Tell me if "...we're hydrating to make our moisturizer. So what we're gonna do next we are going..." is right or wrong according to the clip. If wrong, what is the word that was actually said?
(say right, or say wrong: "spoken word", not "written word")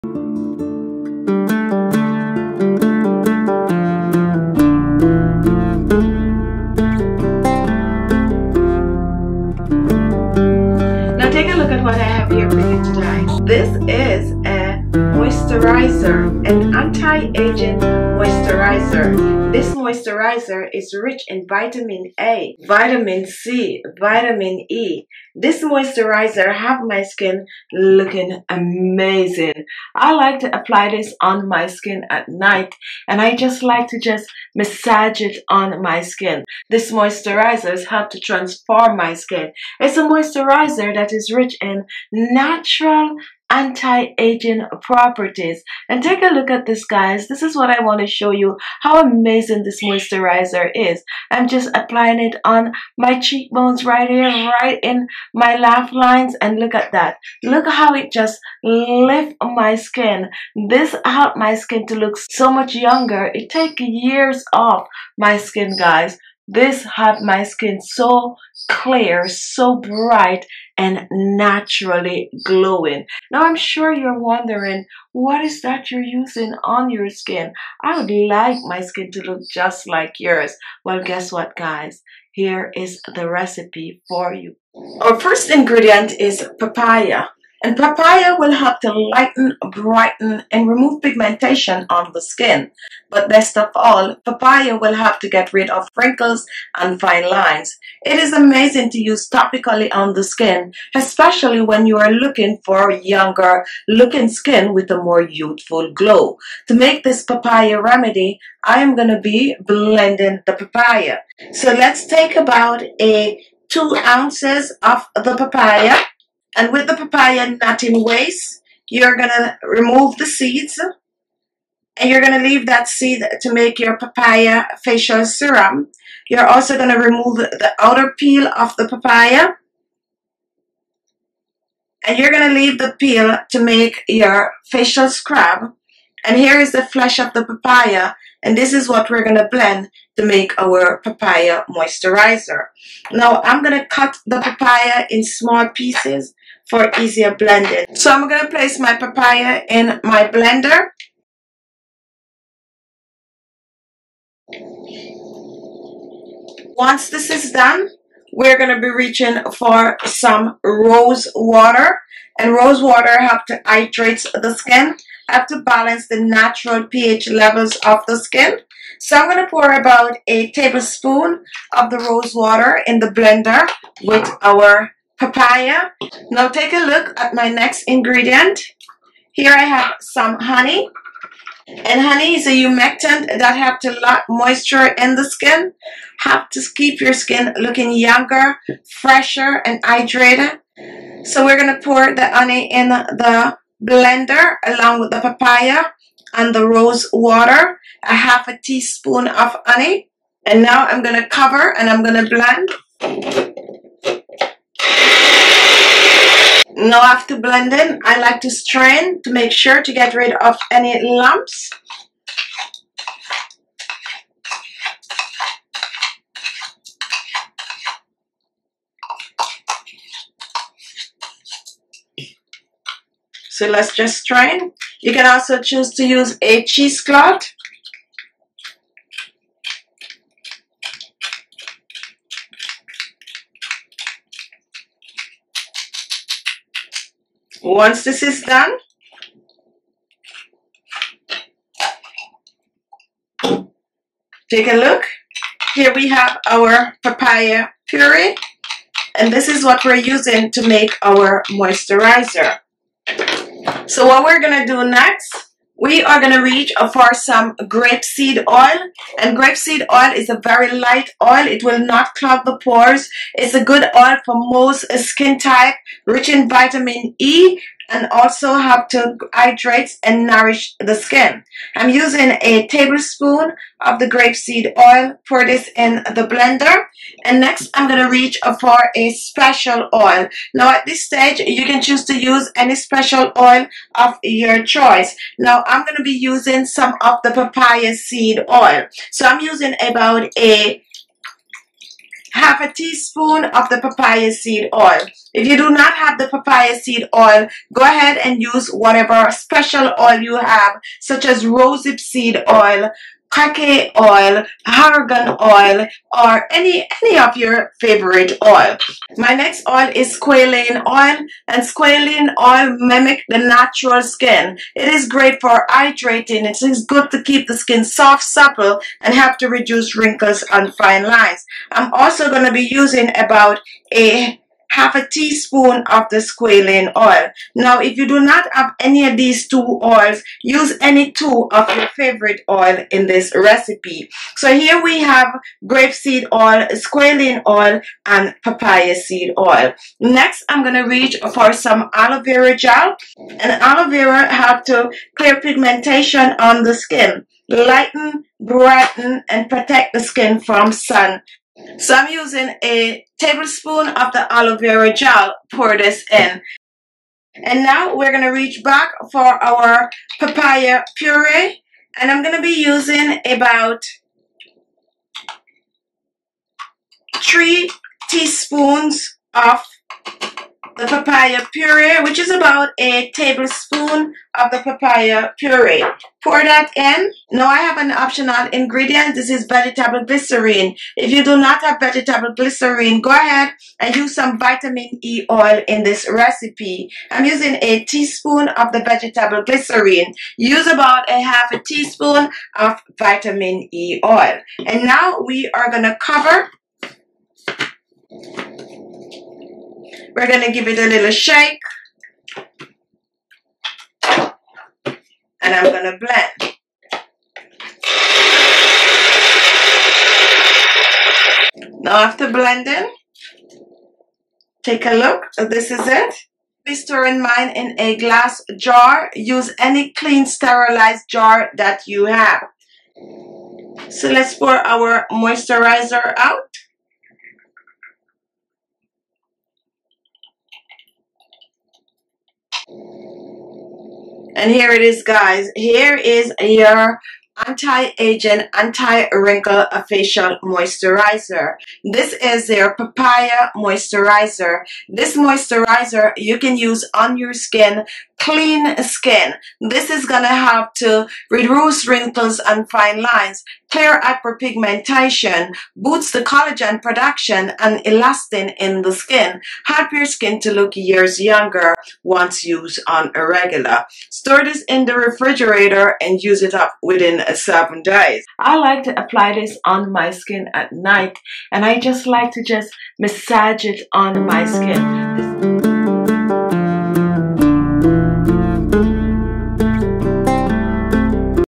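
wrong: "using", not "hydrating".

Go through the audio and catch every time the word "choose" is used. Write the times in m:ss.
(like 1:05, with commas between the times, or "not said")
3:45, 4:41.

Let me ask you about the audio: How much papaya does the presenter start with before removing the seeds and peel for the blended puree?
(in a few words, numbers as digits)
2 ounces.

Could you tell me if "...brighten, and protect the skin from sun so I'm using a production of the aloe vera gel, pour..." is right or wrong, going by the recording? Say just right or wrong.
wrong.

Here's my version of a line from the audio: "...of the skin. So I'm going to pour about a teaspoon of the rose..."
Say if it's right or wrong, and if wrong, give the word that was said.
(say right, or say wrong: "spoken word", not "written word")
wrong: "tablespoon", not "teaspoon".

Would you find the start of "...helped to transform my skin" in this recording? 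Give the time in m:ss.
0:37.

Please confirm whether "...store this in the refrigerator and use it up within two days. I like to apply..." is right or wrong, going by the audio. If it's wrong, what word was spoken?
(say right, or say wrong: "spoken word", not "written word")
wrong: "seven", not "two".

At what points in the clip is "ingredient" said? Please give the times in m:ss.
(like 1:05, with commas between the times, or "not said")
1:25, 2:57, 6:18.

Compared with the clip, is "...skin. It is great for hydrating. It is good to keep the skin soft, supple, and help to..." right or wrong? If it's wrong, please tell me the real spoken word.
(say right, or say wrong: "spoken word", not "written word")
right.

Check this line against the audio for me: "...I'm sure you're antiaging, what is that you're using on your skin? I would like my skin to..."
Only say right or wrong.
wrong.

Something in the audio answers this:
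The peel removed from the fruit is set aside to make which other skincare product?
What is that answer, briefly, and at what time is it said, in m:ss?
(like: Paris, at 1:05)
facial scrub, at 2:14.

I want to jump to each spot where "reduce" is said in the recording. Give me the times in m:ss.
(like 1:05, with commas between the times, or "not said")
5:19, 7:31.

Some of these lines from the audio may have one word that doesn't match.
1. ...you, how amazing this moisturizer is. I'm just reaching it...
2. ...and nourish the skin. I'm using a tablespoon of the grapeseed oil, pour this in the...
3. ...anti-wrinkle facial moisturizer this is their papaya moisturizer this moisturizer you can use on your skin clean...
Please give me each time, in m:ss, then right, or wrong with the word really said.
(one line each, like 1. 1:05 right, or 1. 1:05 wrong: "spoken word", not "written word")
1. 0:48 wrong: "applying", not "reaching"
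2. 4:30 right
3. 7:18 right.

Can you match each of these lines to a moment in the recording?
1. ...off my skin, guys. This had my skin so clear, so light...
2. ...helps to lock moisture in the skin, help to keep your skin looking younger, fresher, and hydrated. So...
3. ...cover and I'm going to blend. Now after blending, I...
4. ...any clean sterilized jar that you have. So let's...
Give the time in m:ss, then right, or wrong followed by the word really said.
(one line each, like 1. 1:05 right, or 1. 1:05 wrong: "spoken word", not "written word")
1. 1:04 wrong: "bright", not "light"
2. 3:03 right
3. 3:21 right
4. 6:59 right.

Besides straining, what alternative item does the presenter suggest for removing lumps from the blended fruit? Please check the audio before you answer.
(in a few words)
cheesecloth.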